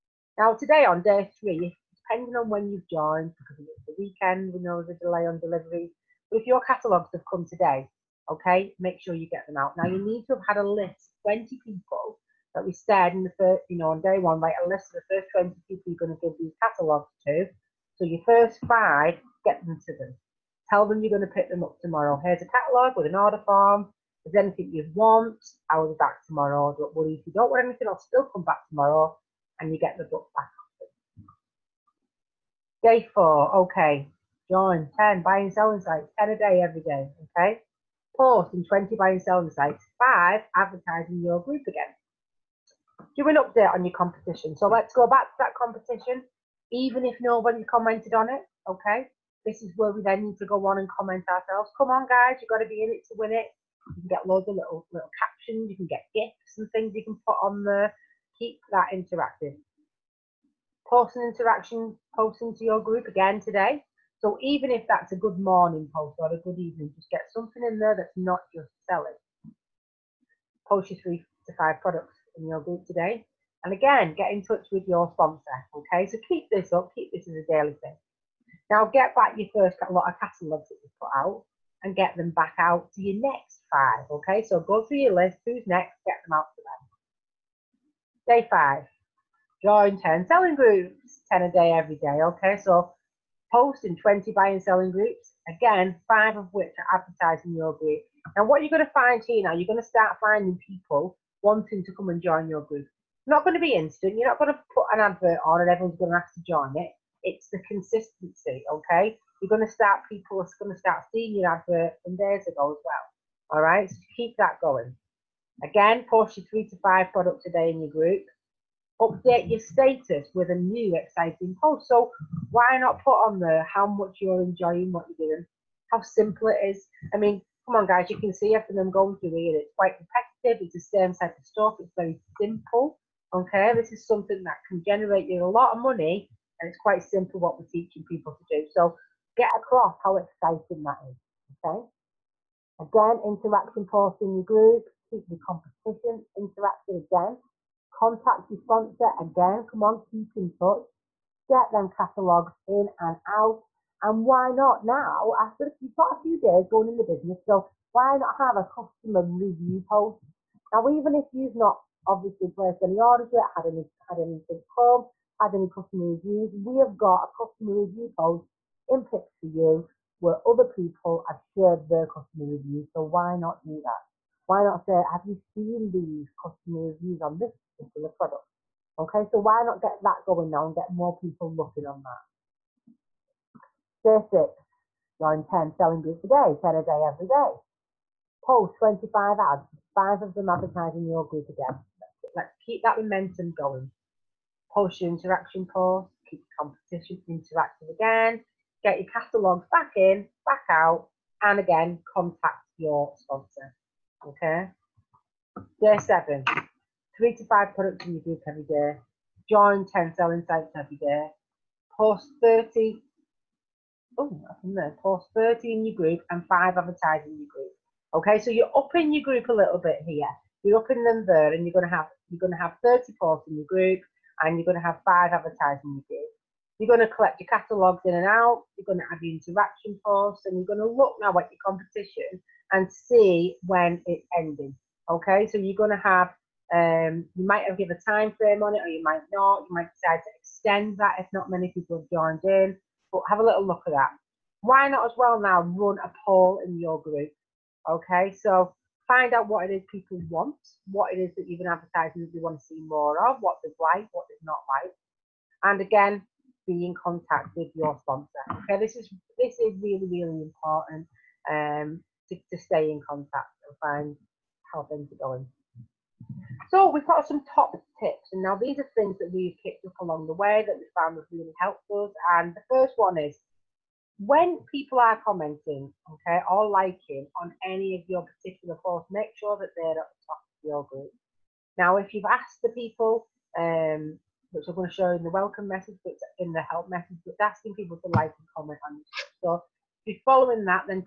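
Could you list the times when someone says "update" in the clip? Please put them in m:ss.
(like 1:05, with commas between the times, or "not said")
0:43, 1:58.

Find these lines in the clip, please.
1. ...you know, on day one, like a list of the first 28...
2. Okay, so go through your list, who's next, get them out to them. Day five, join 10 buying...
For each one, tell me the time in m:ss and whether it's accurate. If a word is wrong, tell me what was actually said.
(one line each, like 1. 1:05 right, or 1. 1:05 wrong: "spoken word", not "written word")
1. 0:13 wrong: "20", not "28"
2. 1:24 wrong: "selling", not "buying".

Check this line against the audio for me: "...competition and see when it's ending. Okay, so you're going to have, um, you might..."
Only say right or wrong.
right.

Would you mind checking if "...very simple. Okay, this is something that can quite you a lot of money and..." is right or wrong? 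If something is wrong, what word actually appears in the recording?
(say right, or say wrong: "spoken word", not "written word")
wrong: "generate", not "quite".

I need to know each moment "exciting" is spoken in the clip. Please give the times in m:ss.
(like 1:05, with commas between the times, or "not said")
2:00, 2:20.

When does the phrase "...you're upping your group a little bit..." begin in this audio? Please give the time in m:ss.
3:38.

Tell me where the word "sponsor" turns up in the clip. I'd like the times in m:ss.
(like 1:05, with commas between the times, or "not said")
1:15, 2:28, 3:23, 4:18.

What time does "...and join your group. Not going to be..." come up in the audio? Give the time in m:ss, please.
1:42.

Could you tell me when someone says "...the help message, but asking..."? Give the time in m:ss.
4:46.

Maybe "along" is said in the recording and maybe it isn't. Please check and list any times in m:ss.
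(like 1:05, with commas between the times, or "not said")
4:29.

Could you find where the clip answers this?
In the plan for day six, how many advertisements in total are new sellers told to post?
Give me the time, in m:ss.
3:08.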